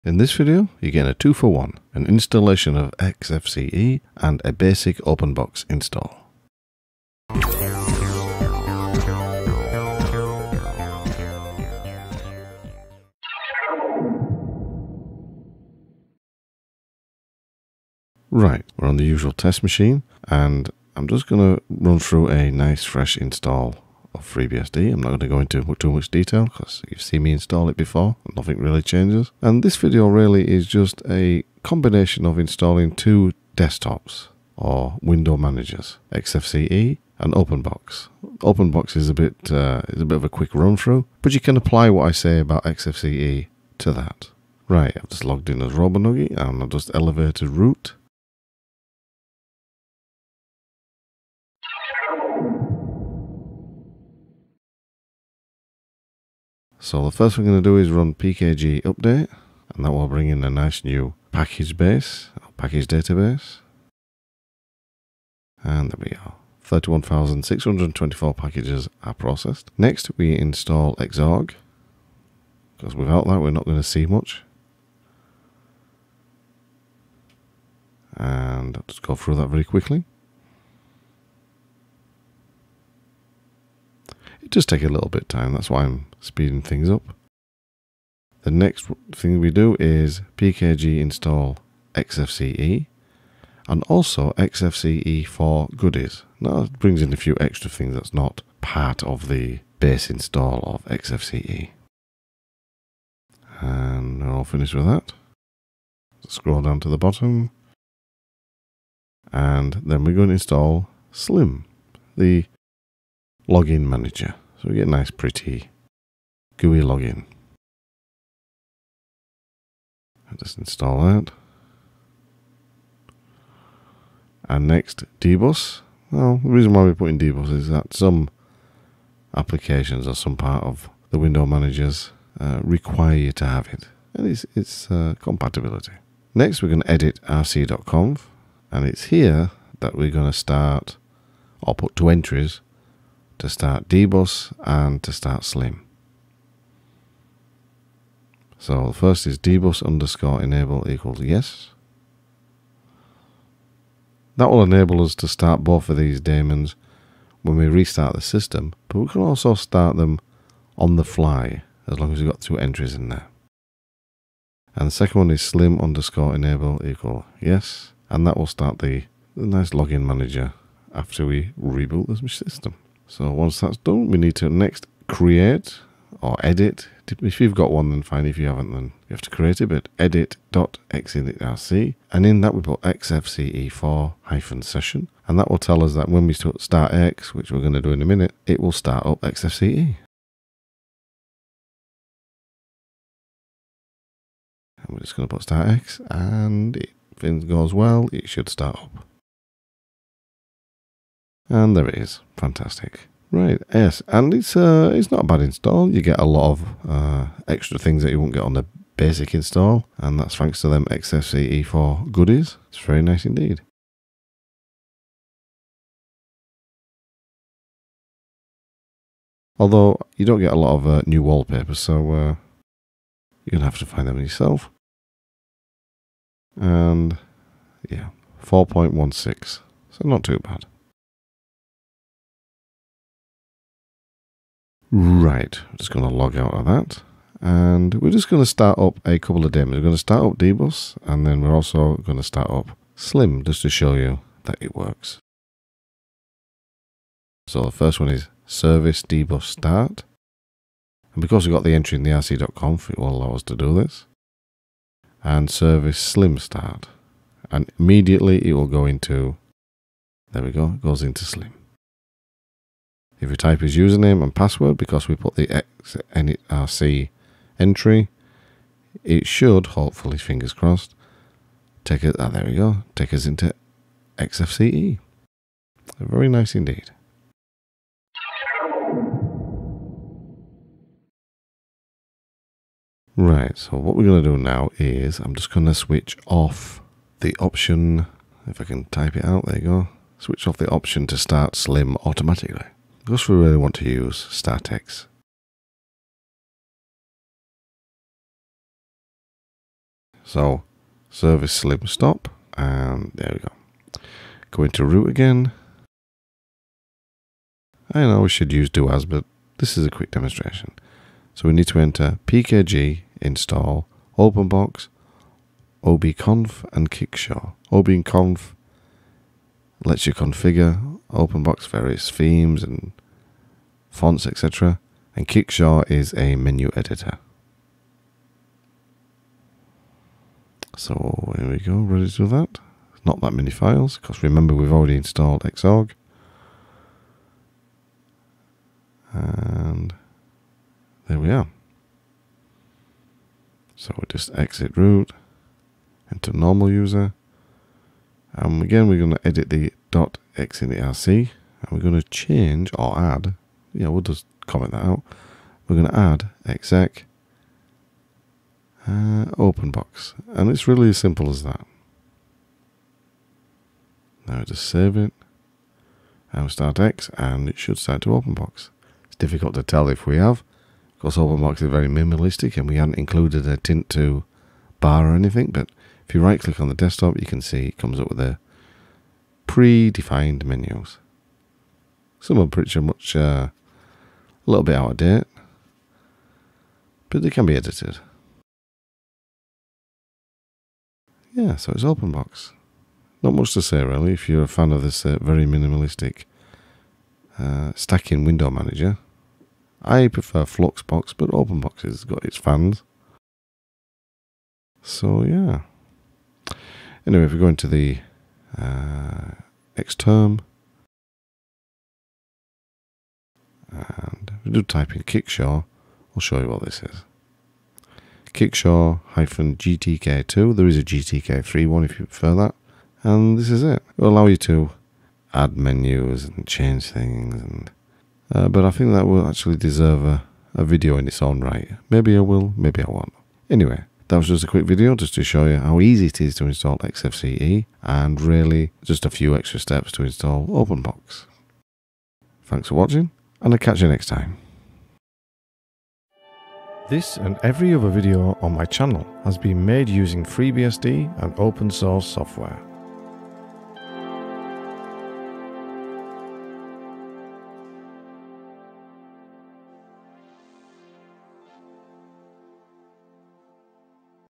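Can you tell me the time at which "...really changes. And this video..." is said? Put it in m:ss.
0:28.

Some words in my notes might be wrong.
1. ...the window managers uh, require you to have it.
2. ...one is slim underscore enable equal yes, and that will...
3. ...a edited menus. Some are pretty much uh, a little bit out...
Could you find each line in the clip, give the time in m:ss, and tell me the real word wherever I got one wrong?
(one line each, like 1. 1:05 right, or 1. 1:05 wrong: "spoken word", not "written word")
1. 2:11 right
2. 2:45 right
3. 6:18 wrong: "predefined", not "edited".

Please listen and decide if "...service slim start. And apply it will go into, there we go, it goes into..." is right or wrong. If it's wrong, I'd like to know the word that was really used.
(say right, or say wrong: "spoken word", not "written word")
wrong: "immediately", not "apply".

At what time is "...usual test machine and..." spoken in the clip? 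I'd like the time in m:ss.
0:19.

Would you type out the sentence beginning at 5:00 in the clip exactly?
So service slim stop and there we go.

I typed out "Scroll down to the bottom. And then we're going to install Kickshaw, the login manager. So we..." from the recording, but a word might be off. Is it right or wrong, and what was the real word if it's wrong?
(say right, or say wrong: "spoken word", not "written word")
wrong: "Slim", not "Kickshaw".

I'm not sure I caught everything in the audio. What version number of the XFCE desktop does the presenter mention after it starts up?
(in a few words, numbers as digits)
4.16.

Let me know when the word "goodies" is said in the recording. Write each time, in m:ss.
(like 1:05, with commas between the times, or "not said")
1:35, 3:32.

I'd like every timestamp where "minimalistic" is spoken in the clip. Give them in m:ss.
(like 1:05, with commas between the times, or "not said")
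6:11, 6:35.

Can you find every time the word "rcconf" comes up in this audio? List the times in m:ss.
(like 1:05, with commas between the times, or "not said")
2:17, 4:12.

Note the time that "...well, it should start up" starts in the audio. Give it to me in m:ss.
3:17.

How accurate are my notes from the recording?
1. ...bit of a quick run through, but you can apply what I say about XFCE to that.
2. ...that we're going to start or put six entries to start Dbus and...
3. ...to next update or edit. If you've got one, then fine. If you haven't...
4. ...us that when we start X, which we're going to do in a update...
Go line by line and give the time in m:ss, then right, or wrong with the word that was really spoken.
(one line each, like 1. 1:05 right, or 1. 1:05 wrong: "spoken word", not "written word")
1. 0:40 right
2. 2:19 wrong: "two", not "six"
3. 2:54 wrong: "create", not "update"
4. 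3:05 wrong: "minute", not "update".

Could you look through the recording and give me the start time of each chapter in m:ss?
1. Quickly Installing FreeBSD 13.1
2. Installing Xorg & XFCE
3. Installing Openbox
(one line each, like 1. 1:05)
1. 0:13
2. 0:51
3. 4:38.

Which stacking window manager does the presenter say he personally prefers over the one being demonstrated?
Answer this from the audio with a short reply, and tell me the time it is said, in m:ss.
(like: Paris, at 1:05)
Fluxbox, at 6:40.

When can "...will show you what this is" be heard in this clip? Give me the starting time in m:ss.
6:56.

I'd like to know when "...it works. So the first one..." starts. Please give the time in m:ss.
4:04.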